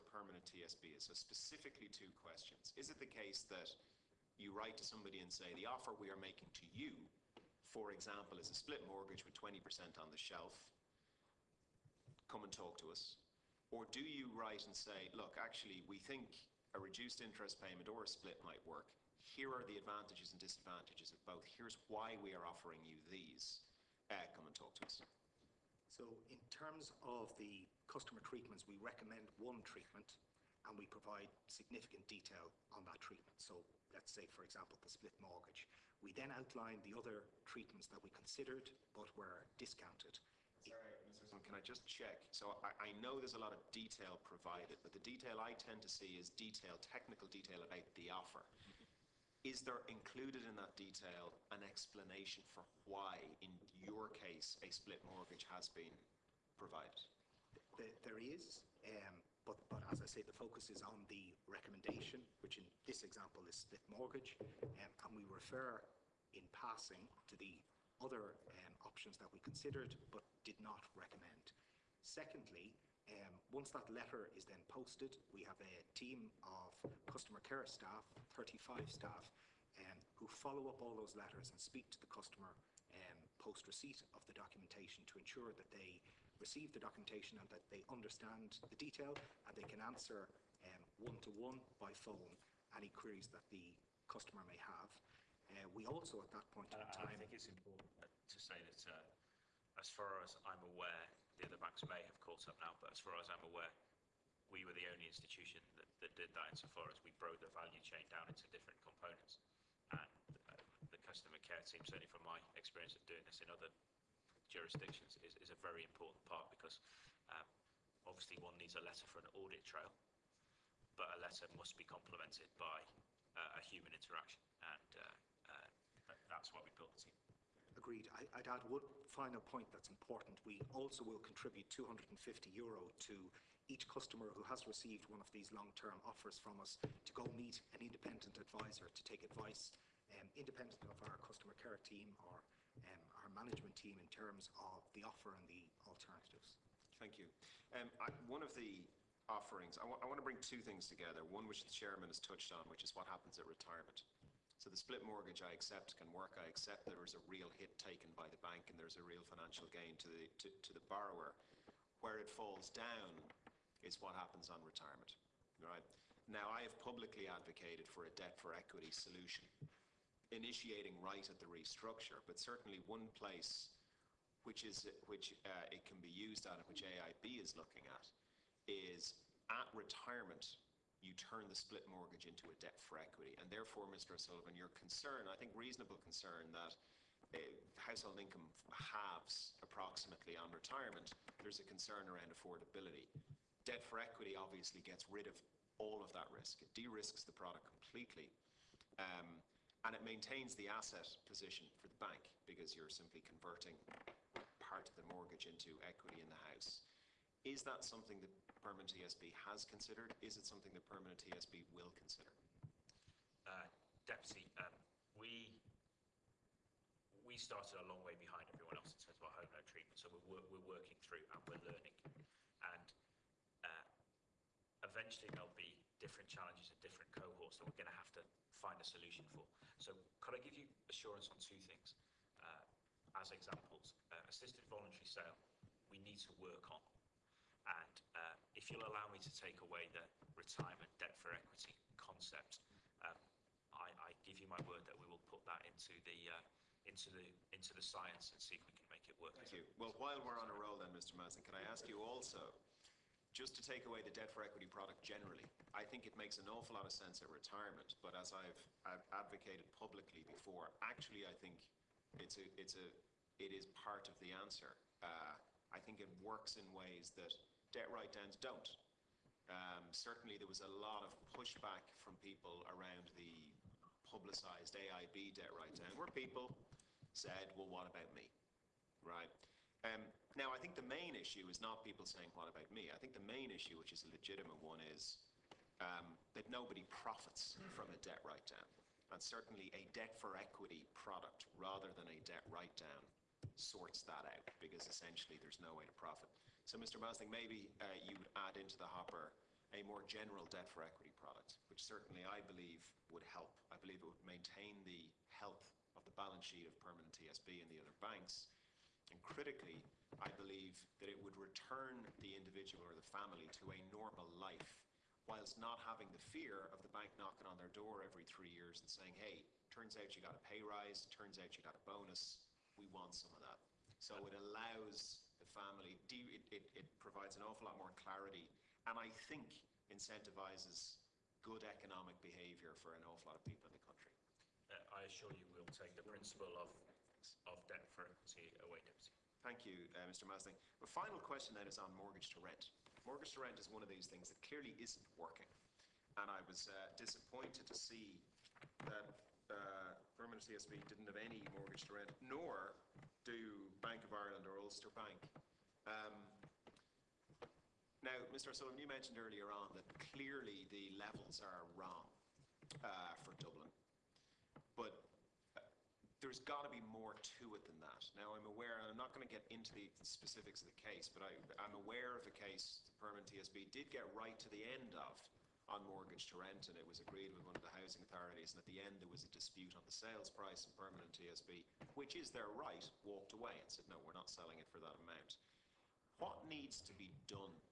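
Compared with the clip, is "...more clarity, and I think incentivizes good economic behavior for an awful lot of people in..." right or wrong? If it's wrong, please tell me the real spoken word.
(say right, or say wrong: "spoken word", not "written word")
right.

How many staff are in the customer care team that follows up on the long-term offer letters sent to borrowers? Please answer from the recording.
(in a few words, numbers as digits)
35.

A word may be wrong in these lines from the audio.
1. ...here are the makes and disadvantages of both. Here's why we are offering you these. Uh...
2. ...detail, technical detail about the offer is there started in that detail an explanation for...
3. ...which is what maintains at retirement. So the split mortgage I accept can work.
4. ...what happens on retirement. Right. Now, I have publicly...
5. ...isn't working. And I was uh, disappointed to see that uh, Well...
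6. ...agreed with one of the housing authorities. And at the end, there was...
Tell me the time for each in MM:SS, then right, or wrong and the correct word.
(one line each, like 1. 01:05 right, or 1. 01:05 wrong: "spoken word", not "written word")
1. 00:19 wrong: "advantages", not "makes"
2. 00:46 wrong: "included", not "started"
3. 02:32 wrong: "happens", not "maintains"
4. 02:44 right
5. 05:44 wrong: "Permanent", not "Well"
6. 06:16 right.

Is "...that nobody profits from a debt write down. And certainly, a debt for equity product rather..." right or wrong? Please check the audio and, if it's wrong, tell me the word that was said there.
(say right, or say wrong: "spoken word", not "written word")
right.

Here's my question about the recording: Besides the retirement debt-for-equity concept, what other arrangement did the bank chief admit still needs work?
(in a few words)
assisted voluntary sale.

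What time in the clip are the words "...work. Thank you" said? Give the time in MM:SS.
04:09.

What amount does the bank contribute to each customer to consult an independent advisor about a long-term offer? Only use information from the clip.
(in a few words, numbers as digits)
250 euro.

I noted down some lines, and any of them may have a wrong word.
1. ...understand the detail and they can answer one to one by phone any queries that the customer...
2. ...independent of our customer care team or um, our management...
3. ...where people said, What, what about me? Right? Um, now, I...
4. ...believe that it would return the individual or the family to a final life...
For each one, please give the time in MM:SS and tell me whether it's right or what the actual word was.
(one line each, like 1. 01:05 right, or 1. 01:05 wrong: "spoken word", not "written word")
1. 01:27 right
2. 02:20 right
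3. 04:35 wrong: "Well", not "What"
4. 05:10 wrong: "normal", not "final".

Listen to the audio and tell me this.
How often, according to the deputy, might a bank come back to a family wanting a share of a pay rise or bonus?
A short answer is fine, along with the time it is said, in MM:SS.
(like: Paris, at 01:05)
every three years, at 05:18.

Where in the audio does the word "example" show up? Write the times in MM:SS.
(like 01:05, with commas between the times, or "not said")
00:07, 00:34, 01:03, 03:53.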